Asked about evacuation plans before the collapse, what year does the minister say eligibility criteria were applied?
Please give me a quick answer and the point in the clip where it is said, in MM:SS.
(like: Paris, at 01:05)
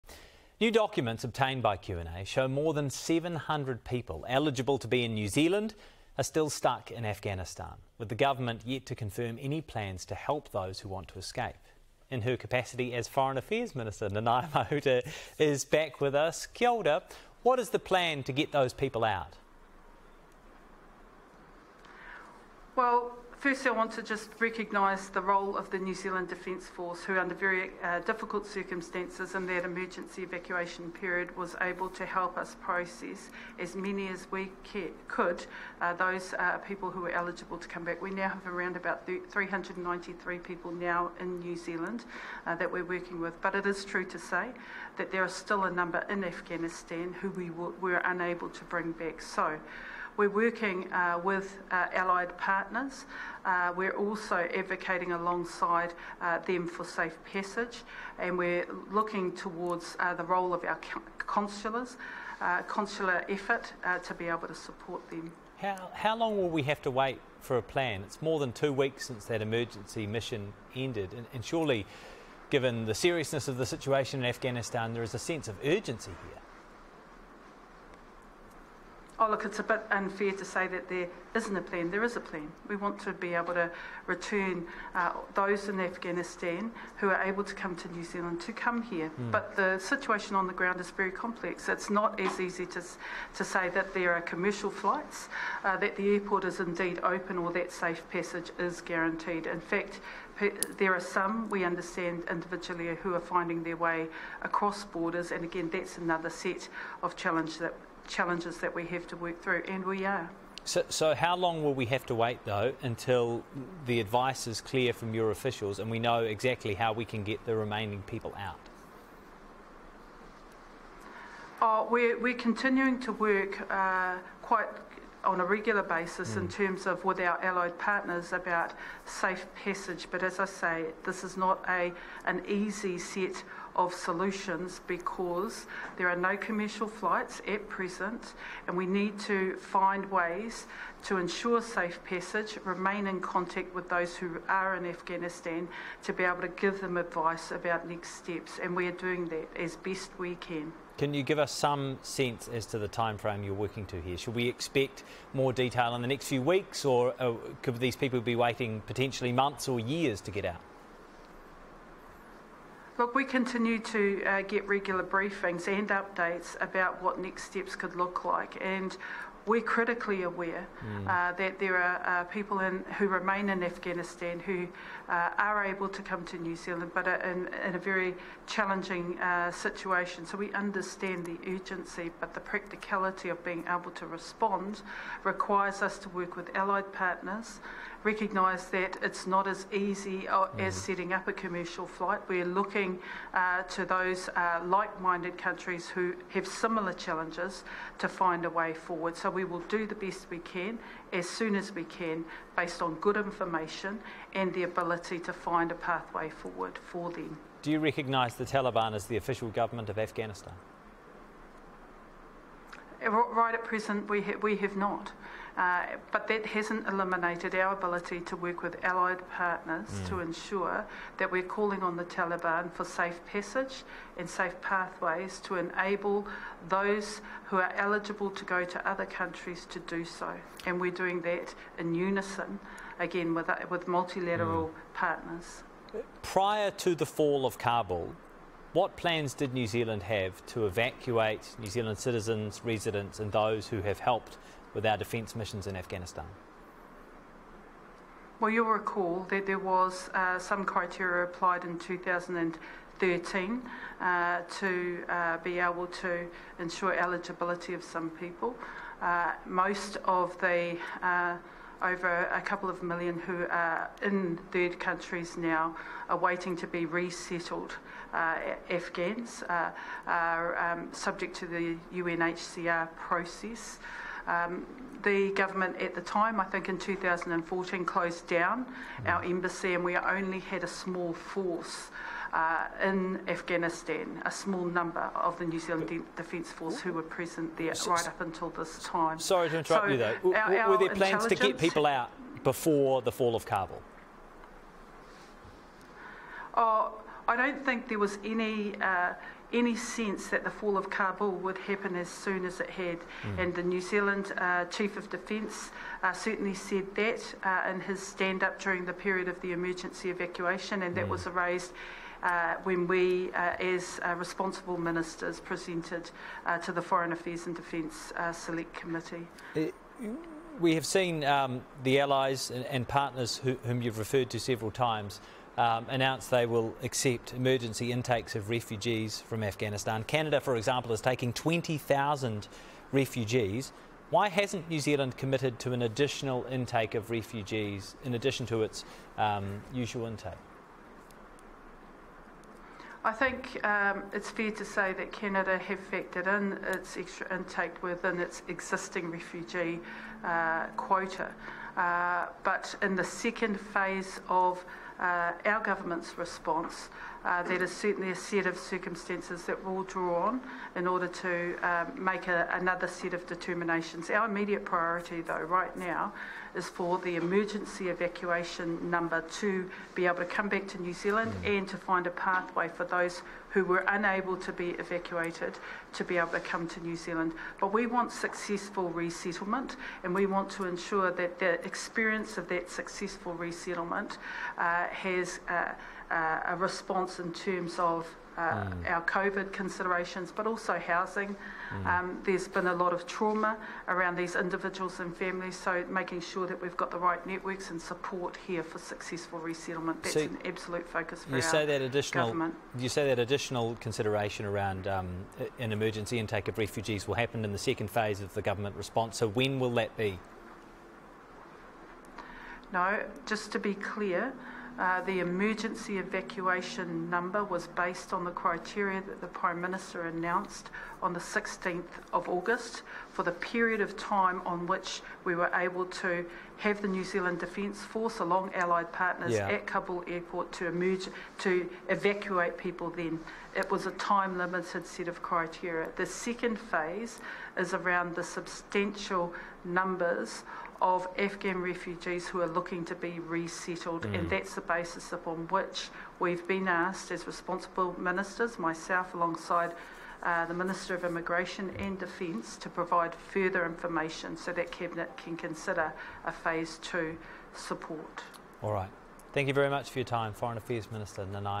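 2013, at 04:11.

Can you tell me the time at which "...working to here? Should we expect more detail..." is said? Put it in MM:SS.
02:33.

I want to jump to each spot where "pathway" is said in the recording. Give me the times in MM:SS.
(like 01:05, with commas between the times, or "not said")
03:25, 03:44, 06:12.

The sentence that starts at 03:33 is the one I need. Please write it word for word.
Right at present, we, ha- we have not.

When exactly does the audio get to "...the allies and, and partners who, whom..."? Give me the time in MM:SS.
05:21.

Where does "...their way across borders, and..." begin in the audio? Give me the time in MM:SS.
01:43.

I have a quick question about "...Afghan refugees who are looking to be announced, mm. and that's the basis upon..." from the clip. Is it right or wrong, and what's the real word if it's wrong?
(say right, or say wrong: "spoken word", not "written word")
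wrong: "resettled", not "announced".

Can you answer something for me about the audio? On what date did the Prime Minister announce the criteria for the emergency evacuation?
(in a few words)
16 August.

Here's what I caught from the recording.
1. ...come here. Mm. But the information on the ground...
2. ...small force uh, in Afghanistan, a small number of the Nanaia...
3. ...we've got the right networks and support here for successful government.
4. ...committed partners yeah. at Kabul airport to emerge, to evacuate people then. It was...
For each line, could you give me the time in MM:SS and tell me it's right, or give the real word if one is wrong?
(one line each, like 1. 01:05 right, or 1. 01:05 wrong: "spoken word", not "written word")
1. 01:28 wrong: "situation", not "information"
2. 04:40 wrong: "New", not "Nanaia"
3. 06:36 wrong: "resettlement", not "government"
4. 07:08 wrong: "allied", not "committed".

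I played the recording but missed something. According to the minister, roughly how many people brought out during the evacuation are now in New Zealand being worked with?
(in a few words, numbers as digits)
393.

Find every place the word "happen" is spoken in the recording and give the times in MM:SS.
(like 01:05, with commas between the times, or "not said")
05:01, 06:47.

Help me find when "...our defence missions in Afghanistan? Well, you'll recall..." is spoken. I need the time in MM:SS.
04:04.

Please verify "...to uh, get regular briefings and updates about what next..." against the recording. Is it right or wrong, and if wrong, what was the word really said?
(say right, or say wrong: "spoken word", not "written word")
right.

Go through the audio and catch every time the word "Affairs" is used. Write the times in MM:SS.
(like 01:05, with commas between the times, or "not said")
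00:13, 05:17, 07:40.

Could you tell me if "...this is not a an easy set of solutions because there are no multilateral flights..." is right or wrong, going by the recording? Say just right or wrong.
wrong.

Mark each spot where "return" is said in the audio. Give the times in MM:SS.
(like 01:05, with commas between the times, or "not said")
01:24.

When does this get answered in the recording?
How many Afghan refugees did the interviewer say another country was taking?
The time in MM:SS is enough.
05:31.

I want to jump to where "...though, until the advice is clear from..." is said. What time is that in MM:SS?
01:52.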